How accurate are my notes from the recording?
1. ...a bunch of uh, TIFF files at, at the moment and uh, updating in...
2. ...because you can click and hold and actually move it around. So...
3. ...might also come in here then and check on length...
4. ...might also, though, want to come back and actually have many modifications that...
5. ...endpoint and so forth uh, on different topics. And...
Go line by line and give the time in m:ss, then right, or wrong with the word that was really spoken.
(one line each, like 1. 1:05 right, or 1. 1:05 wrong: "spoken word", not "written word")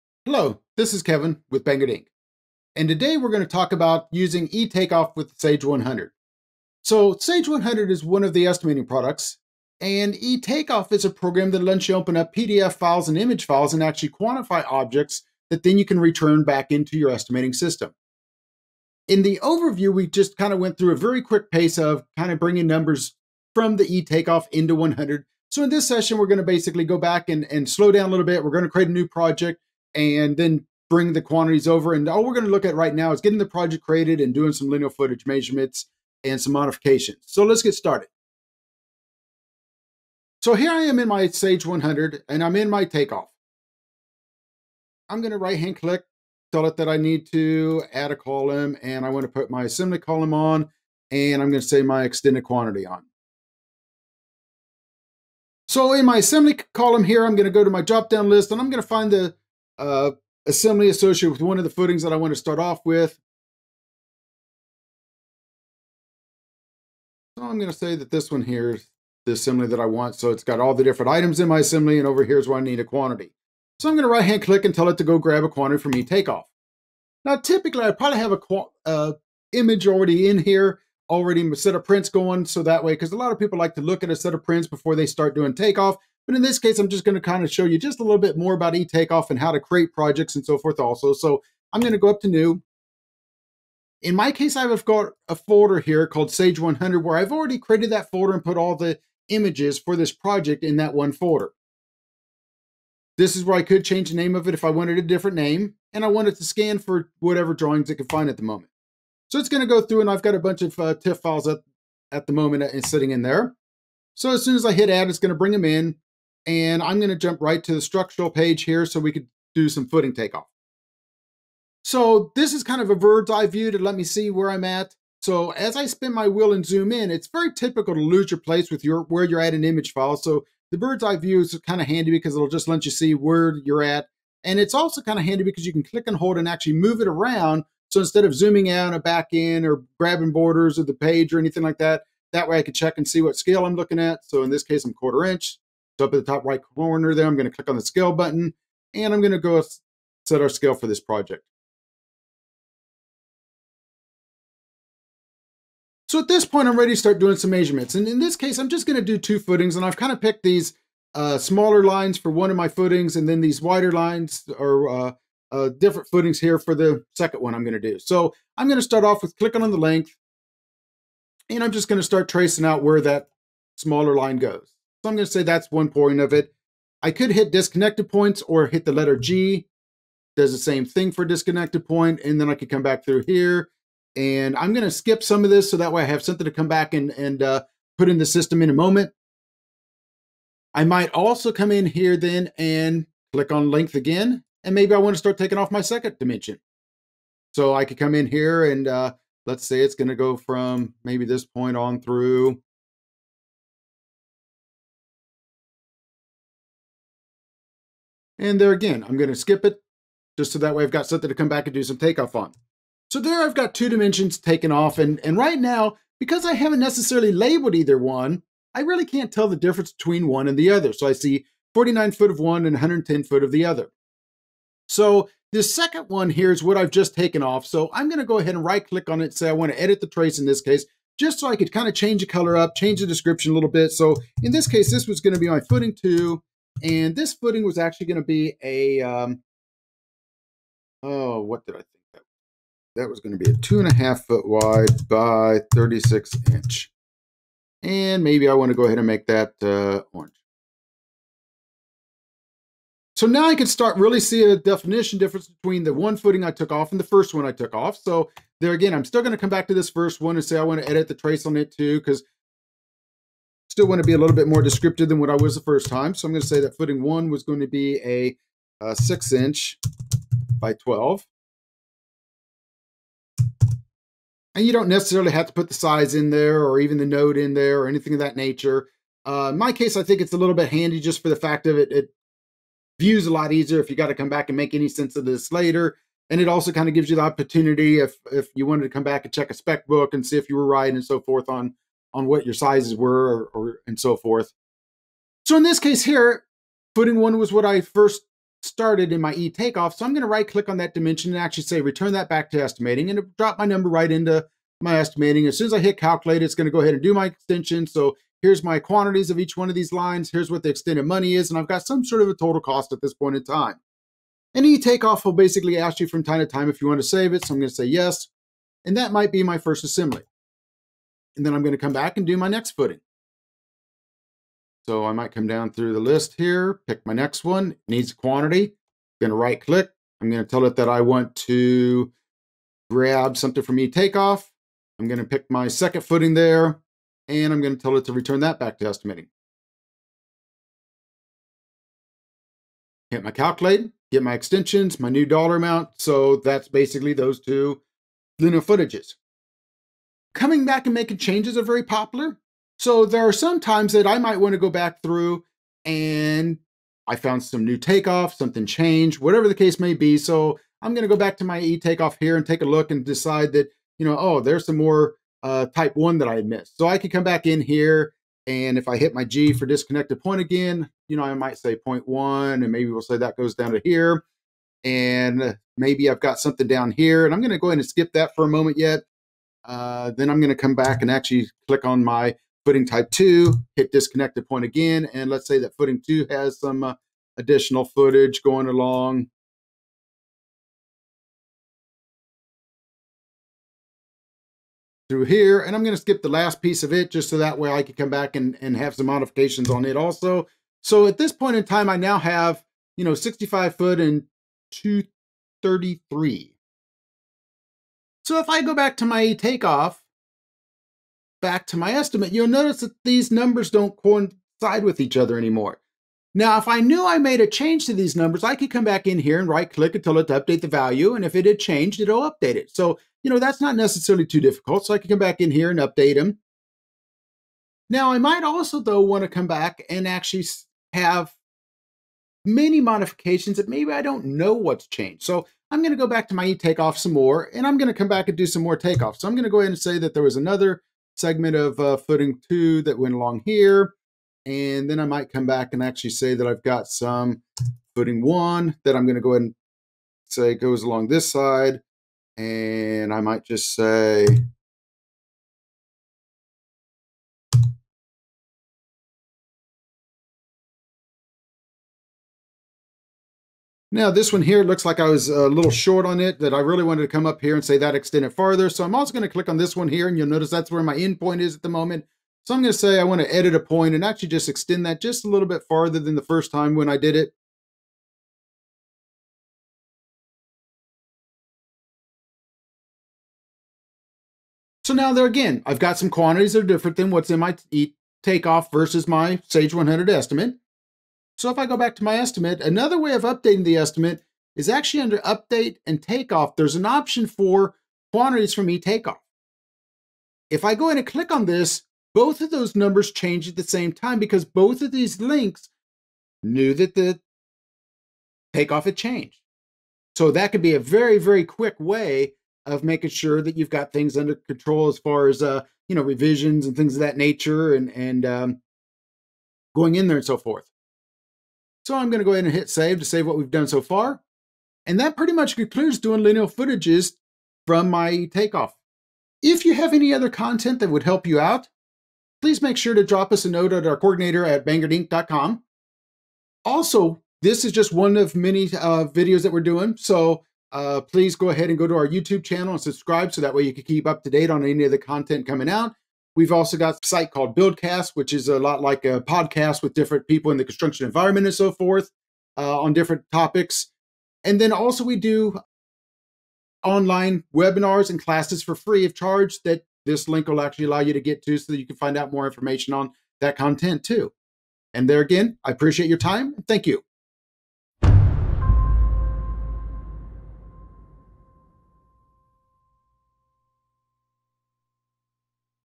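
1. 1:50 wrong: "sitting", not "updating"
2. 2:15 right
3. 3:10 wrong: "click", not "check"
4. 7:08 right
5. 9:11 wrong: "environment", not "endpoint".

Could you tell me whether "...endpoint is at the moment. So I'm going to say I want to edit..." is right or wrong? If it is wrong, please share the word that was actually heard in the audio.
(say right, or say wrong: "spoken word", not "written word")
right.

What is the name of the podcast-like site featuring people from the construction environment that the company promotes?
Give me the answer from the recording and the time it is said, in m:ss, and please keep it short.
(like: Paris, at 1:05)
Buildcast, at 9:07.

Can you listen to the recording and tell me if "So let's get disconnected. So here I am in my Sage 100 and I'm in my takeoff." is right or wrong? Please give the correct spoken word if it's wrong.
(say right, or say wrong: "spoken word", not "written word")
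wrong: "started", not "disconnected".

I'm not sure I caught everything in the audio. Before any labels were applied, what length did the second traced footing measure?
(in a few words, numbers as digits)
110 feet.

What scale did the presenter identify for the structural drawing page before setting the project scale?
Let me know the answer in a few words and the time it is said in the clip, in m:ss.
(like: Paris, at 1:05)
Quarter inch, at 2:24.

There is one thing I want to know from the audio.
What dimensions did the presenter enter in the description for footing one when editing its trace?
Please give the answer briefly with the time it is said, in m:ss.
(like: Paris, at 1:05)
6 inch by 12, at 4:28.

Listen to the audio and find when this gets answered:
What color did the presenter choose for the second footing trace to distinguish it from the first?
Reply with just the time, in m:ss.
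4:10.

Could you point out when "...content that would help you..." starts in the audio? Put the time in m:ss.
8:50.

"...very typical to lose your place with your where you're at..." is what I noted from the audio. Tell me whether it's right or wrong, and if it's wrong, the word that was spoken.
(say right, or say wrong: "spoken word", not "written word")
right.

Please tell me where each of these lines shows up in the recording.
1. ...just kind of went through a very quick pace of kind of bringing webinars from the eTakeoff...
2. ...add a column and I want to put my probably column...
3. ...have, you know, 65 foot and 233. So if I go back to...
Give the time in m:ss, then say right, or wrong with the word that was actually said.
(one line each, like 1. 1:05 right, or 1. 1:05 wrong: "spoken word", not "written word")
1. 0:20 wrong: "numbers", not "webinars"
2. 0:47 wrong: "assembly", not "probably"
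3. 6:42 right.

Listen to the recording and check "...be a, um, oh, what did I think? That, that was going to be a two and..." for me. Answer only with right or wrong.
right.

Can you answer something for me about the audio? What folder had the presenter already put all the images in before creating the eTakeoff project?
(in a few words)
Sage 100.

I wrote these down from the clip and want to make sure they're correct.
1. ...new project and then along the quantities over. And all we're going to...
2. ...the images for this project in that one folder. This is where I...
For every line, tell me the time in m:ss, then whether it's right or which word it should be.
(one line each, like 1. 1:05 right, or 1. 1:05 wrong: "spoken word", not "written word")
1. 0:28 wrong: "bring", not "along"
2. 1:38 right.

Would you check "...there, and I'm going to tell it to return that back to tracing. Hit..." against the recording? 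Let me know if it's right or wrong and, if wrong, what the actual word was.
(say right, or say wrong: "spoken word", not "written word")
wrong: "estimating", not "tracing".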